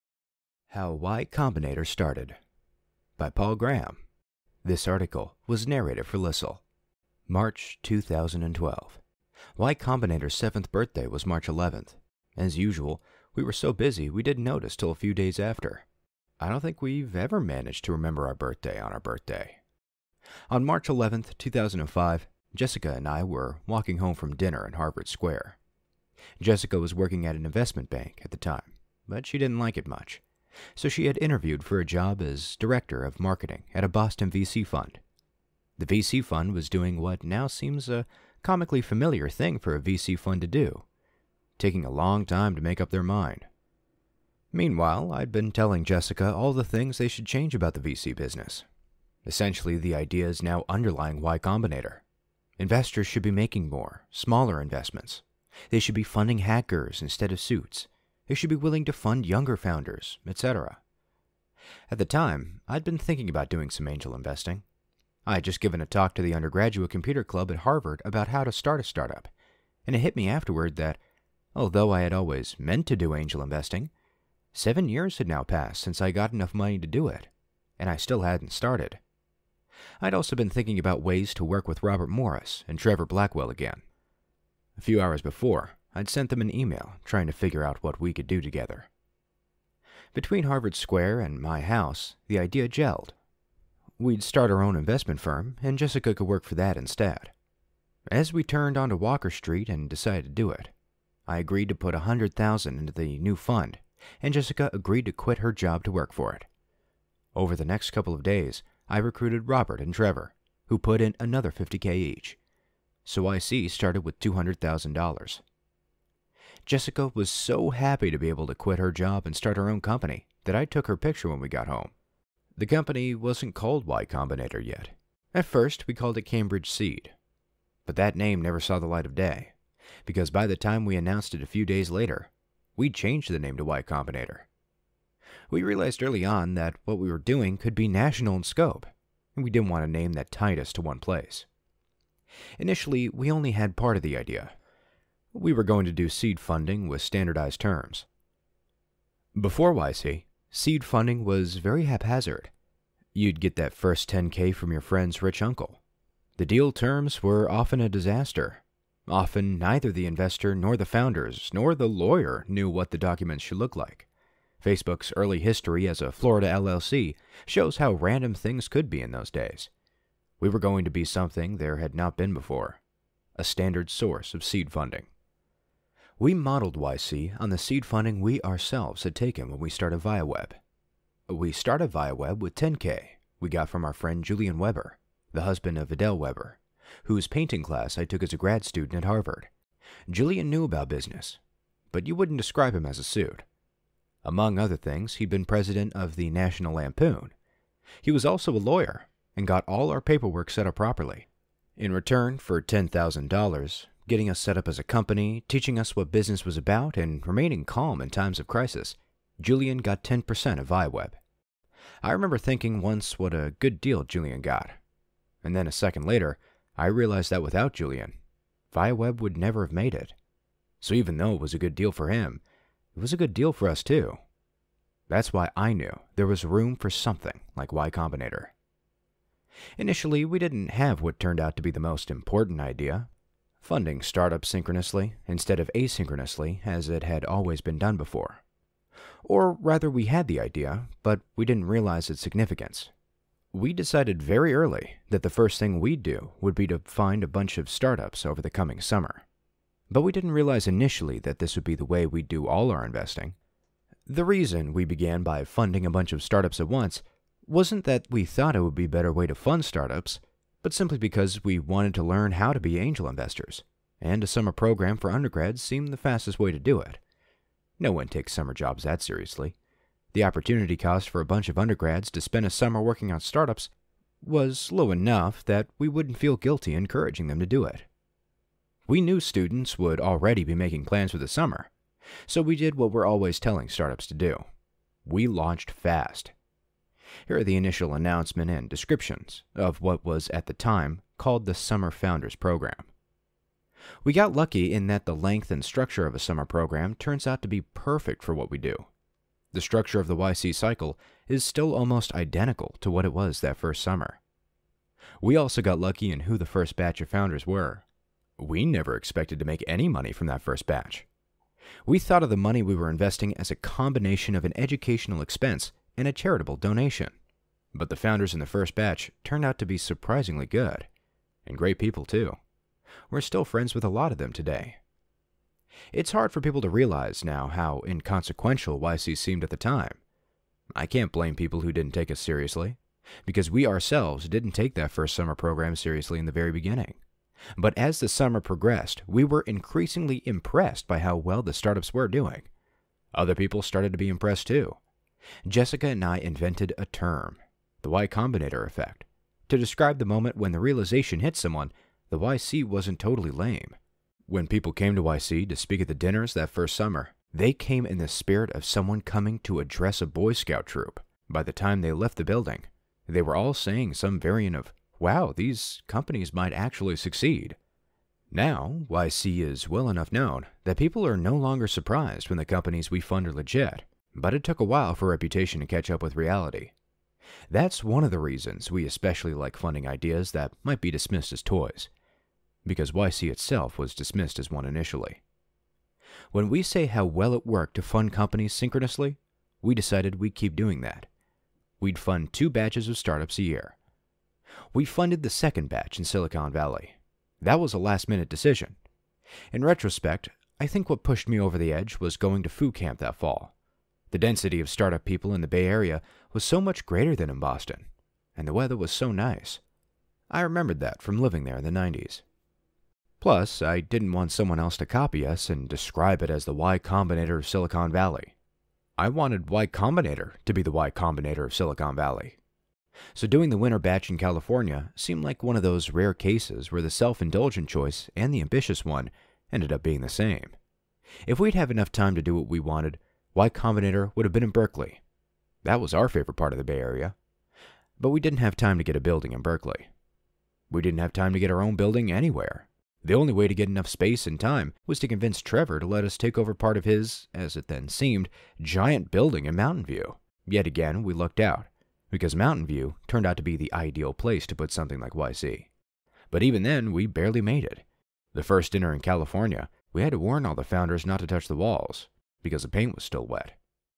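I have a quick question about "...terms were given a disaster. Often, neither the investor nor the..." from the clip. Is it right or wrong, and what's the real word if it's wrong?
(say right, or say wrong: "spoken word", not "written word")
wrong: "often", not "given".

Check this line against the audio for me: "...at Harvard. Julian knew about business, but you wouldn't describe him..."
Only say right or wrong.
right.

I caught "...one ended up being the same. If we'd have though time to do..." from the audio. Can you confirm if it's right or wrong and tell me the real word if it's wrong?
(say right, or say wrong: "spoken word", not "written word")
wrong: "enough", not "though".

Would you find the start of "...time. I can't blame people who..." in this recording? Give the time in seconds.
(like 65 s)
329 s.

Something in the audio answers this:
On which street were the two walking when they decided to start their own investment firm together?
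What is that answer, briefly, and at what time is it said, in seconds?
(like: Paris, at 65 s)
Walker Street, at 98 s.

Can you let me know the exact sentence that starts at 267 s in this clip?
No one takes summer jobs that seriously.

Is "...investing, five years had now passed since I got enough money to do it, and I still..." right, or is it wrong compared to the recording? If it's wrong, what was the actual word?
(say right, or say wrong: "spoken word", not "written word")
wrong: "seven", not "five".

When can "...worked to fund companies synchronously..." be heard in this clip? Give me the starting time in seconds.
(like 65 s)
387 s.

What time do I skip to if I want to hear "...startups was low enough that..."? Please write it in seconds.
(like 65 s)
273 s.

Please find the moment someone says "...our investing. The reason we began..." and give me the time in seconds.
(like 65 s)
252 s.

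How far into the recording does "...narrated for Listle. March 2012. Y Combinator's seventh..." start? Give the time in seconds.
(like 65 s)
5 s.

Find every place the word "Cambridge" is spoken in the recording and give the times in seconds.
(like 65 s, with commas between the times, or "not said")
126 s.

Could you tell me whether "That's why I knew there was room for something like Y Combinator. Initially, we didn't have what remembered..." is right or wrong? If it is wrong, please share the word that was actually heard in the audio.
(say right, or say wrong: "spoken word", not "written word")
wrong: "turned", not "remembered".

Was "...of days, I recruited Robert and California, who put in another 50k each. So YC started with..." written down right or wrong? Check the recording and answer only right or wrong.
wrong.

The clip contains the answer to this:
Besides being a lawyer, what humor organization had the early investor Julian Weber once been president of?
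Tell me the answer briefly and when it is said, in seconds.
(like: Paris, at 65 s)
National Lampoon, at 196 s.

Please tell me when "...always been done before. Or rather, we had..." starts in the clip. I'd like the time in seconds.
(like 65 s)
237 s.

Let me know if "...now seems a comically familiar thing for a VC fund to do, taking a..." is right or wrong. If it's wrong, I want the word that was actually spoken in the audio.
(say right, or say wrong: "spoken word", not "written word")
right.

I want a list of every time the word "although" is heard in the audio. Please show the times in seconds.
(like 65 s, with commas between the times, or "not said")
71 s.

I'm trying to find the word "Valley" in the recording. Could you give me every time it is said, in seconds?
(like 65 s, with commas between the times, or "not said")
396 s, 417 s, 421 s.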